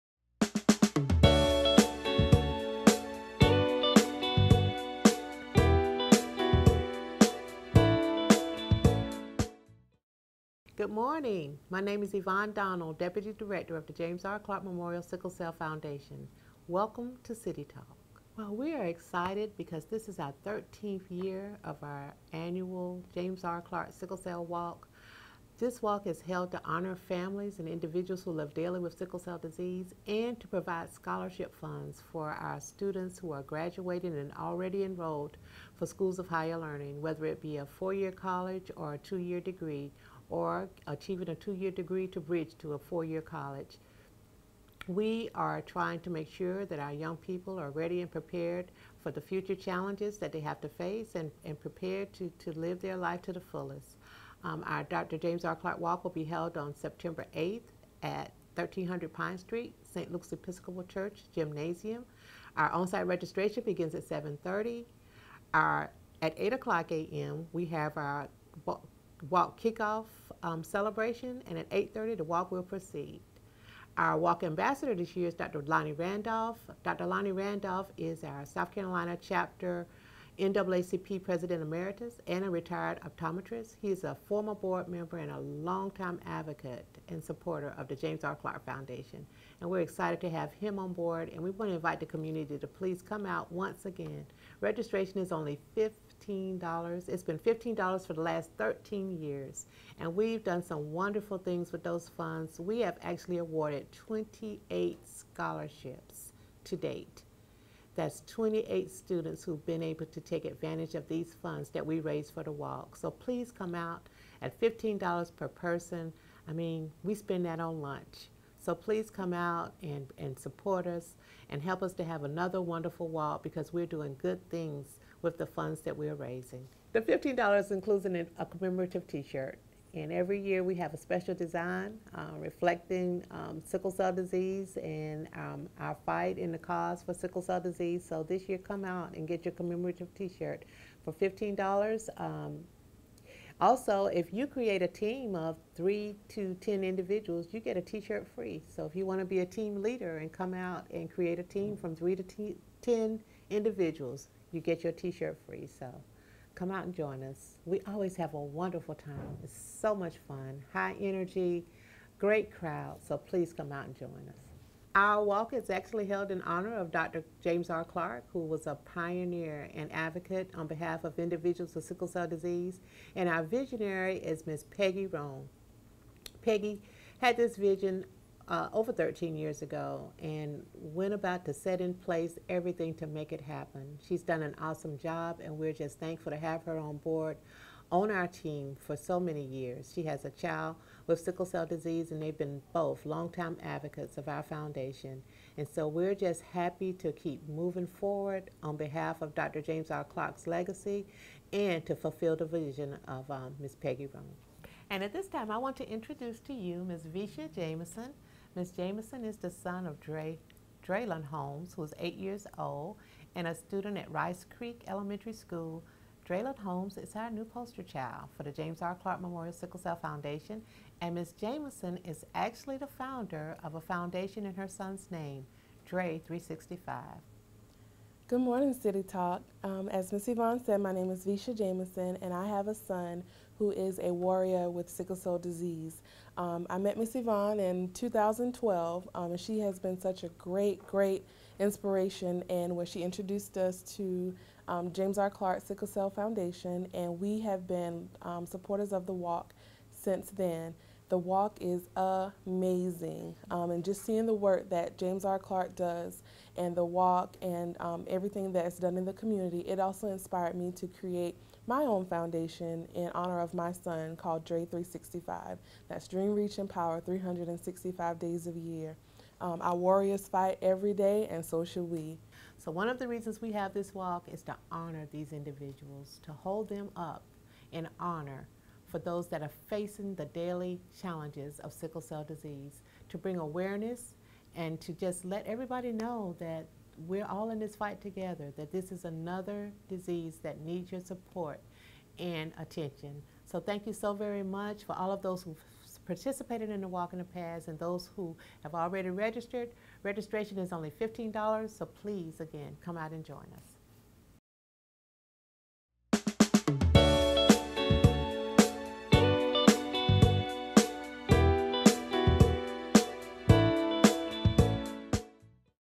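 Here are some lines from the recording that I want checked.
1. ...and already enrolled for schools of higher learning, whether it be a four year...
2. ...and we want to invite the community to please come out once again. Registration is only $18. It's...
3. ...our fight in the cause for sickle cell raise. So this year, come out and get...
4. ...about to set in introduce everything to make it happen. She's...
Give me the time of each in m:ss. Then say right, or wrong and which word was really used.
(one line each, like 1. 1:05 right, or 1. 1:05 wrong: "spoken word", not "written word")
1. 0:34 right
2. 1:31 wrong: "15", not "18"
3. 2:15 wrong: "disease", not "raise"
4. 3:01 wrong: "place", not "introduce".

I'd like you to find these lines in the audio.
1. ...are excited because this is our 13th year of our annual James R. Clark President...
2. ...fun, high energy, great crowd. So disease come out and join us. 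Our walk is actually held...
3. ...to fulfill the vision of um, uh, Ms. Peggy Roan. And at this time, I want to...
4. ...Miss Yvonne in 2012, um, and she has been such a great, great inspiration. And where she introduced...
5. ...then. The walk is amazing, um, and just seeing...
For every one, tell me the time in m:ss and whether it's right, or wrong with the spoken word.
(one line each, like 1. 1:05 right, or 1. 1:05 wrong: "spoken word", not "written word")
1. 0:18 wrong: "Sickle", not "President"
2. 2:40 wrong: "please", not "disease"
3. 3:21 right
4. 3:56 right
5. 4:10 right.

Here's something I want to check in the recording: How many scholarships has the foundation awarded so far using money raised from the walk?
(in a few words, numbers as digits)
28.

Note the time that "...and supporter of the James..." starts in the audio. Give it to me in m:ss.
1:27.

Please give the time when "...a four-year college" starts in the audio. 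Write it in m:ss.
0:42.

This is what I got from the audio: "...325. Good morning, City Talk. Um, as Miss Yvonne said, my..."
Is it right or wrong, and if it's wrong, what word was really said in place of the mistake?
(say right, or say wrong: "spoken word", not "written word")
wrong: "365", not "325".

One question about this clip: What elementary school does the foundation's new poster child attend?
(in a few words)
Rice Creek Elementary School.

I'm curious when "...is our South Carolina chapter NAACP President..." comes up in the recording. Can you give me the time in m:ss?
1:17.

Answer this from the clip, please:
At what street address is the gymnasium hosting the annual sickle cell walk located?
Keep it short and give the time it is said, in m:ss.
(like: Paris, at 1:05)
1300 Pine Street, at 0:58.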